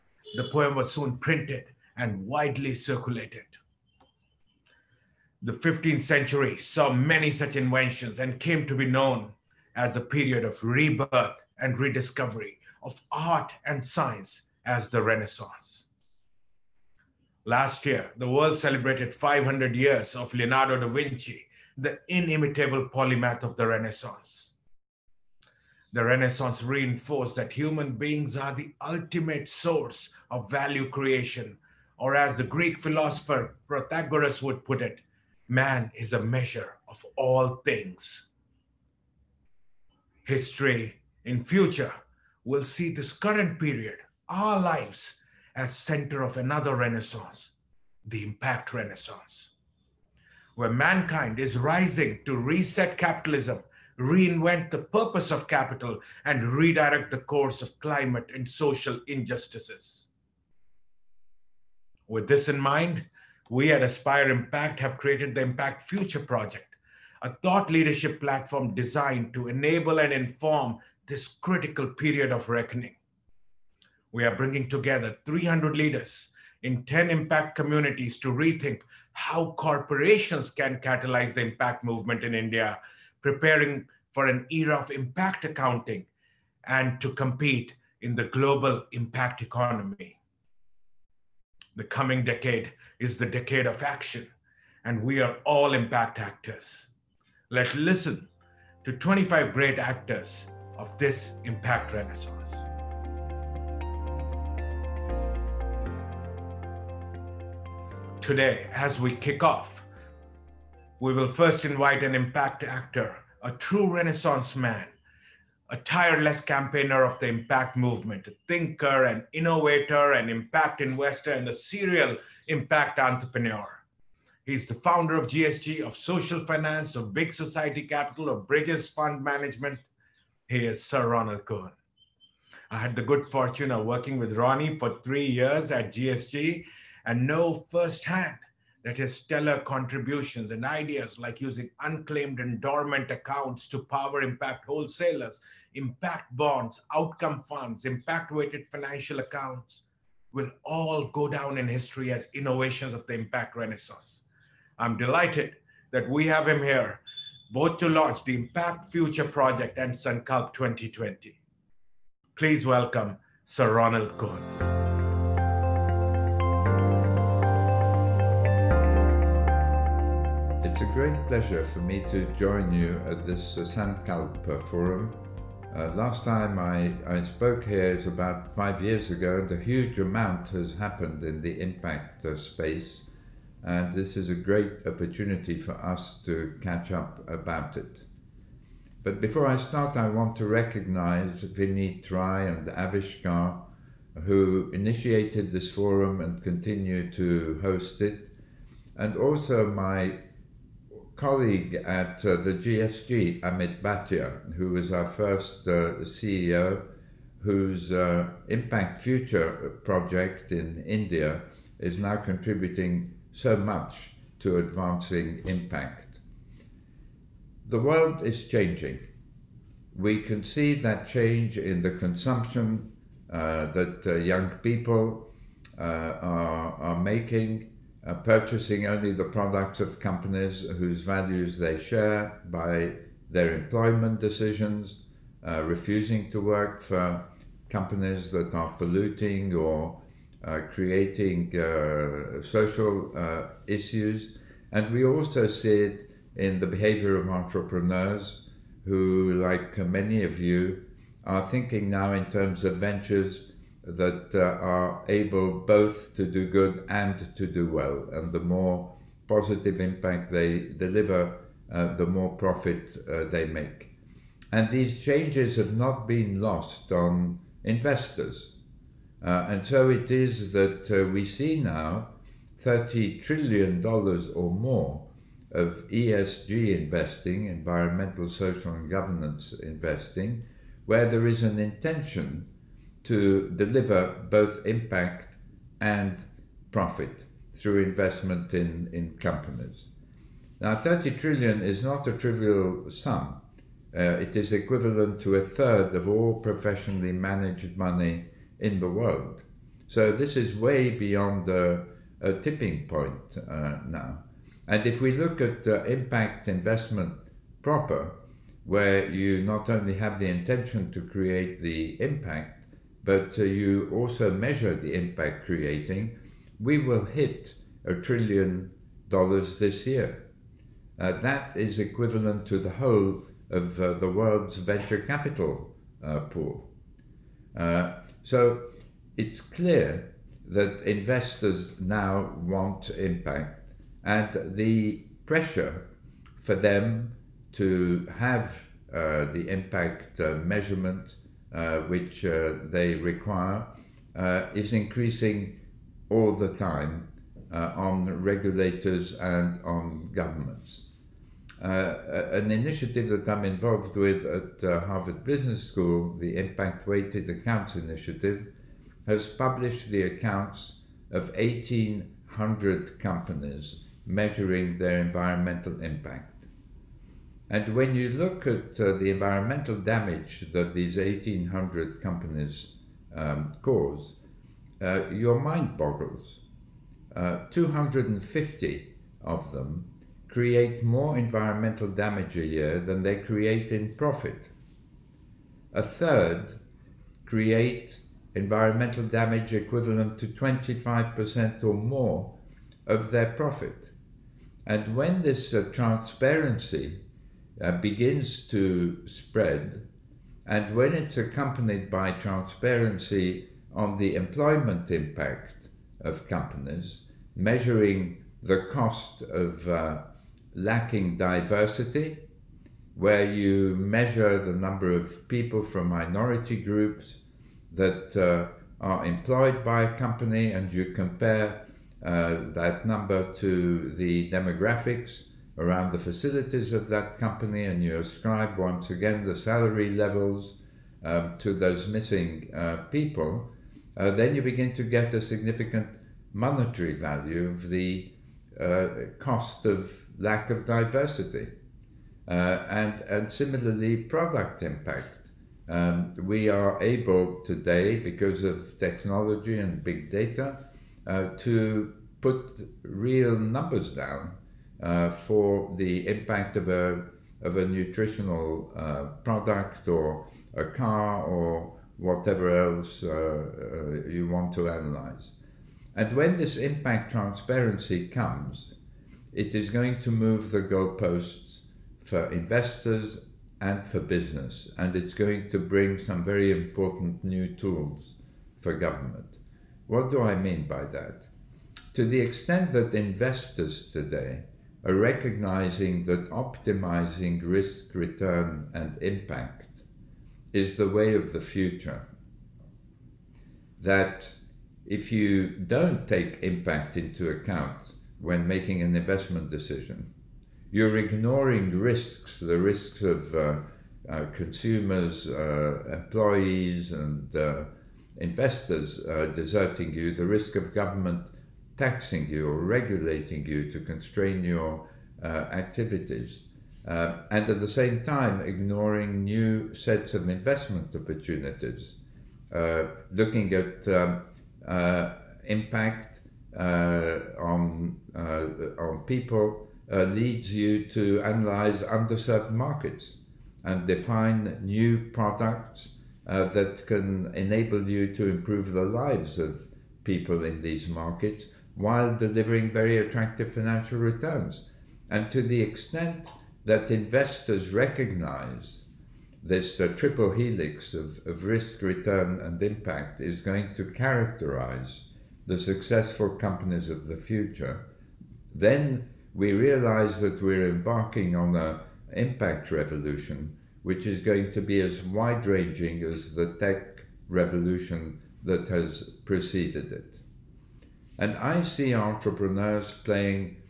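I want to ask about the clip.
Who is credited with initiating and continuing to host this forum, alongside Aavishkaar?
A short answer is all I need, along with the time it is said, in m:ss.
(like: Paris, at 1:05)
Vineet Rai, at 3:11.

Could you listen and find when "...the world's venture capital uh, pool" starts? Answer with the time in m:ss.
5:23.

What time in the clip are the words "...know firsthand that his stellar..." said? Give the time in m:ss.
2:17.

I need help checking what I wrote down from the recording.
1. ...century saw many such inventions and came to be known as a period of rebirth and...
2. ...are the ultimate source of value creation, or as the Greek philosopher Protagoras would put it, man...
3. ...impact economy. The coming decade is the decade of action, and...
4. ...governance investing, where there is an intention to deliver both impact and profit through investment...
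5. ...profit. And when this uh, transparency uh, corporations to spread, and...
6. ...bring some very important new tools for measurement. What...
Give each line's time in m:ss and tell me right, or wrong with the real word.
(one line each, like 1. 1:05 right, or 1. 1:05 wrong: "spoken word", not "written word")
1. 0:06 right
2. 0:28 right
3. 1:28 right
4. 4:38 right
5. 6:33 wrong: "begins", not "corporations"
6. 7:55 wrong: "government", not "measurement".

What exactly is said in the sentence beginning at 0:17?
Last year, the world celebrated 500 years of Leonardo da Vinci, the inimitable polymath of the Renaissance.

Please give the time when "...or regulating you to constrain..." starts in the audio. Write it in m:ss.
8:32.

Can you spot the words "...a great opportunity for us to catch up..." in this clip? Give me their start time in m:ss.
3:04.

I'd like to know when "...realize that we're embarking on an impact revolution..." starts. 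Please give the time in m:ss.
9:19.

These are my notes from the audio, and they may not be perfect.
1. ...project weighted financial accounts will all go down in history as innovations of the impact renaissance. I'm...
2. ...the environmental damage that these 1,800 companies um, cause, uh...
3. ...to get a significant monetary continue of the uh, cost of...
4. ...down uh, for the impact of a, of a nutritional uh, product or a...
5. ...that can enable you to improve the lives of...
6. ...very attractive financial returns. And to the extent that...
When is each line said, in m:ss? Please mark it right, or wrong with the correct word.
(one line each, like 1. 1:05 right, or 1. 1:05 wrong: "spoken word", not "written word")
1. 2:27 wrong: "impact", not "project"
2. 6:08 right
3. 7:14 wrong: "value", not "continue"
4. 7:33 right
5. 8:56 right
6. 9:02 right.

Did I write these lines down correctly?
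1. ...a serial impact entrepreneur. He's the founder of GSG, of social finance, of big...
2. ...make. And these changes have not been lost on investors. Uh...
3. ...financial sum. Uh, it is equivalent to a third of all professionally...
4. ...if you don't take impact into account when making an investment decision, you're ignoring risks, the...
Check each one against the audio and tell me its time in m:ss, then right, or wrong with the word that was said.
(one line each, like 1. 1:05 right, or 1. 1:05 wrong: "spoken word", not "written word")
1. 2:01 right
2. 4:23 right
3. 4:52 wrong: "trivial", not "financial"
4. 8:14 right.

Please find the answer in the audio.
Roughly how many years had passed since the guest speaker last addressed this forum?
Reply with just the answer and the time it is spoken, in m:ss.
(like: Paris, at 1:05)
5 years, at 2:58.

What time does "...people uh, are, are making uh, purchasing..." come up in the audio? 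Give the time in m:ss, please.
3:44.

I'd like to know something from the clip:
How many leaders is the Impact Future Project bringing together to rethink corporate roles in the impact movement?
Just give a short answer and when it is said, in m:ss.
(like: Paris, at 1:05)
300, at 1:15.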